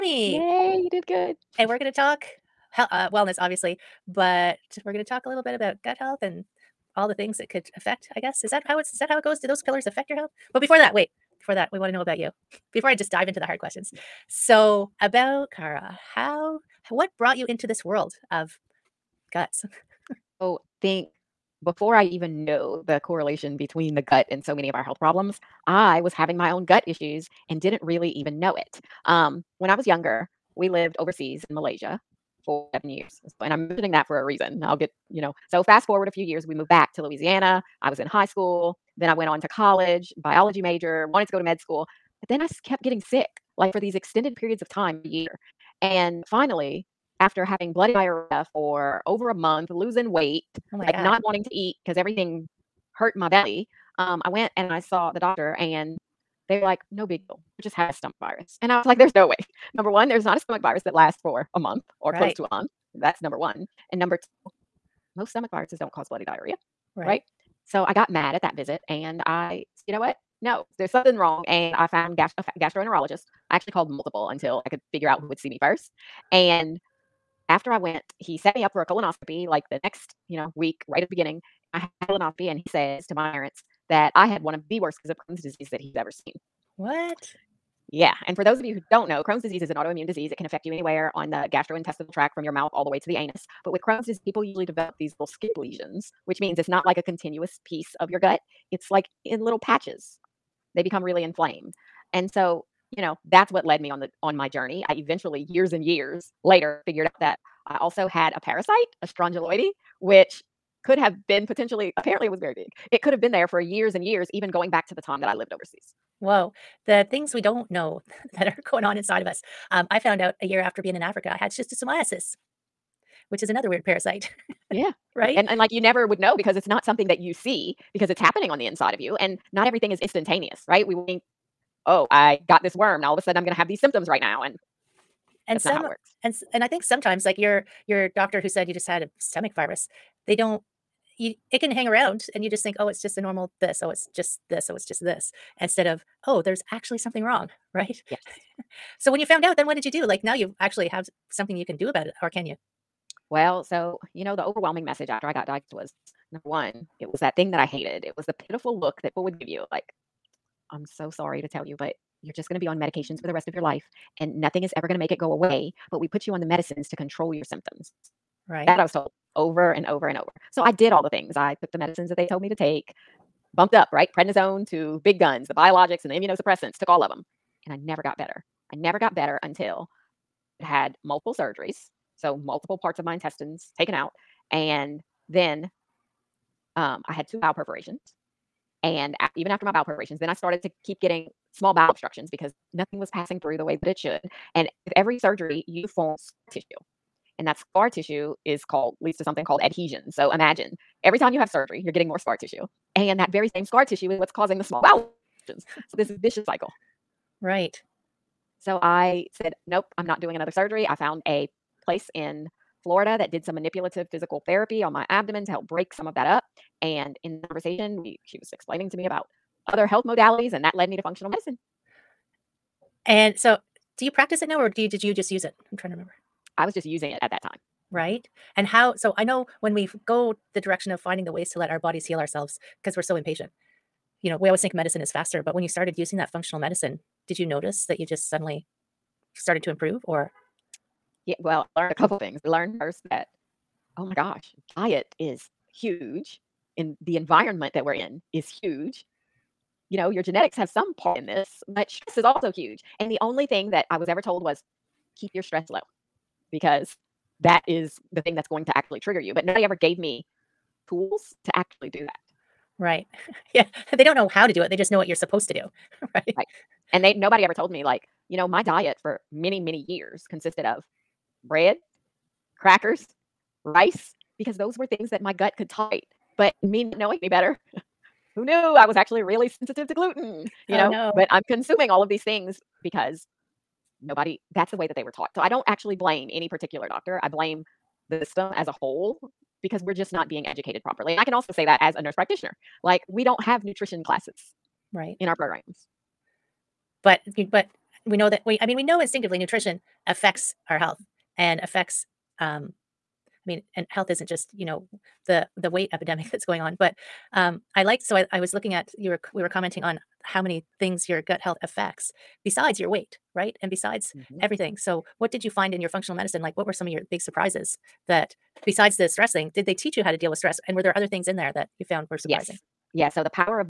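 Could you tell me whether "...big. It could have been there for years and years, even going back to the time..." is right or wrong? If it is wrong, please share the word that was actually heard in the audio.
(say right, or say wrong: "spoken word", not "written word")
right.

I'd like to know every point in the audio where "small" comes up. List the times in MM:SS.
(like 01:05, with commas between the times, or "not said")
03:11, 03:24.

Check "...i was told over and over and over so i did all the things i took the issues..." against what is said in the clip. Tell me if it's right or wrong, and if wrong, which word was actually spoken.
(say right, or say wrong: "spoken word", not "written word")
wrong: "medicines", not "issues".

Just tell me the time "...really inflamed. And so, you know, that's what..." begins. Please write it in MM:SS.
01:41.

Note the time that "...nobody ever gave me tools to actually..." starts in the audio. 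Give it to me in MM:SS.
04:19.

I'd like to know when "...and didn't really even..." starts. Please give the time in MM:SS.
00:27.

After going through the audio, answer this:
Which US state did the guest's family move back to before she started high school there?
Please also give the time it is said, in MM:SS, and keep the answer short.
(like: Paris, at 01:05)
Louisiana, at 00:37.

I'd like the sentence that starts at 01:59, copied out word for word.
Um, I found out a year after being in Africa, I had schistosomiasis which is another weird parasite.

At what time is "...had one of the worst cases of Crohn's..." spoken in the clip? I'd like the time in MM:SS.
01:24.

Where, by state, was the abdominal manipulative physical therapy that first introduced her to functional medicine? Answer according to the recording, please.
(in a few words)
Florida.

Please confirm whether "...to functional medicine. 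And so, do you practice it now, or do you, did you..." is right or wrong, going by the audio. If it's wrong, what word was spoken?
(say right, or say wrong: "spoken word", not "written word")
right.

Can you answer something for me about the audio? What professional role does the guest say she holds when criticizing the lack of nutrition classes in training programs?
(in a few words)
Nurse practitioner.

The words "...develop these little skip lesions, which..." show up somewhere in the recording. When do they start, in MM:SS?
01:34.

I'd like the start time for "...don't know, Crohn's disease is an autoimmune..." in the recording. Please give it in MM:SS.
01:28.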